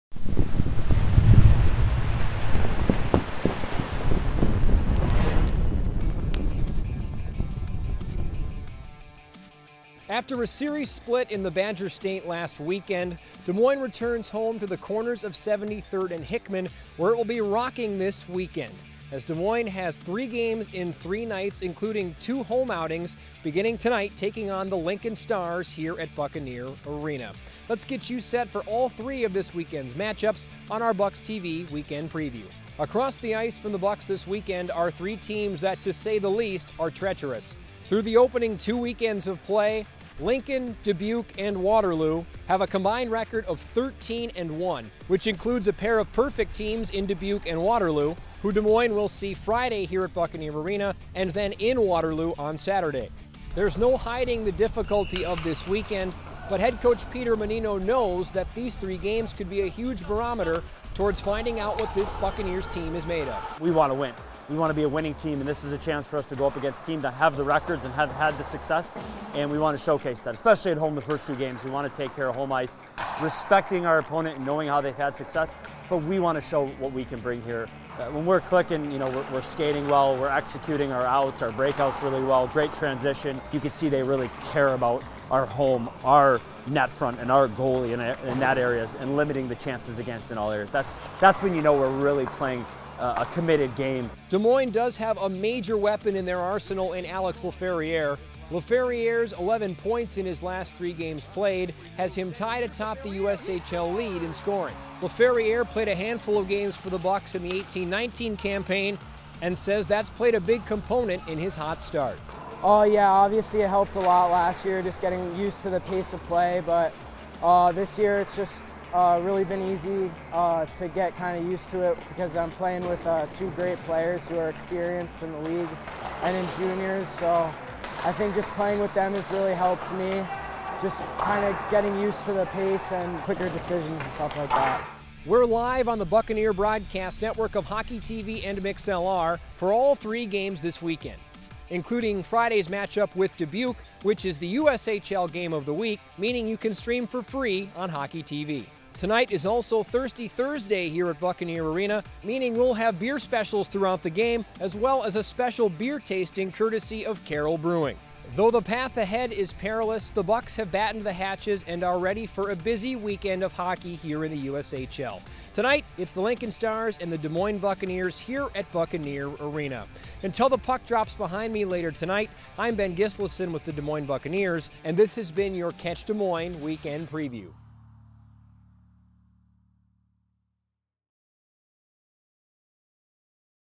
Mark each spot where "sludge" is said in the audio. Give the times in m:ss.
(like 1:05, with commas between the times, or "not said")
not said.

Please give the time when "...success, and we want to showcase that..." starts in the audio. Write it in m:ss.
1:08.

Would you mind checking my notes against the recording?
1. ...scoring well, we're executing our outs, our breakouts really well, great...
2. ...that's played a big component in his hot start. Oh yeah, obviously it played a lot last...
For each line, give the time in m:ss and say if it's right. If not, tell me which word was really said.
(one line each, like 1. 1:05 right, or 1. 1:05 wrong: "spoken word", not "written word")
1. 1:19 wrong: "skating", not "scoring"
2. 1:49 wrong: "helped", not "played".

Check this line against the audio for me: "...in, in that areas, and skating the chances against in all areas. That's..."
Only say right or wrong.
wrong.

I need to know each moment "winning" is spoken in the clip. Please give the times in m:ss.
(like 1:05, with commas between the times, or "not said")
1:04.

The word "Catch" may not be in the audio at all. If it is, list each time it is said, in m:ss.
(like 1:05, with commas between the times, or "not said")
2:55.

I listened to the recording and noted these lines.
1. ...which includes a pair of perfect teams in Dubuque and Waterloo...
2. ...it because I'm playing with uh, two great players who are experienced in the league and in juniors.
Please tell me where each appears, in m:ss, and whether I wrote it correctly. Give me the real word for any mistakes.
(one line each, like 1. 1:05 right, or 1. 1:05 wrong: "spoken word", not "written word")
1. 0:45 right
2. 2:01 right.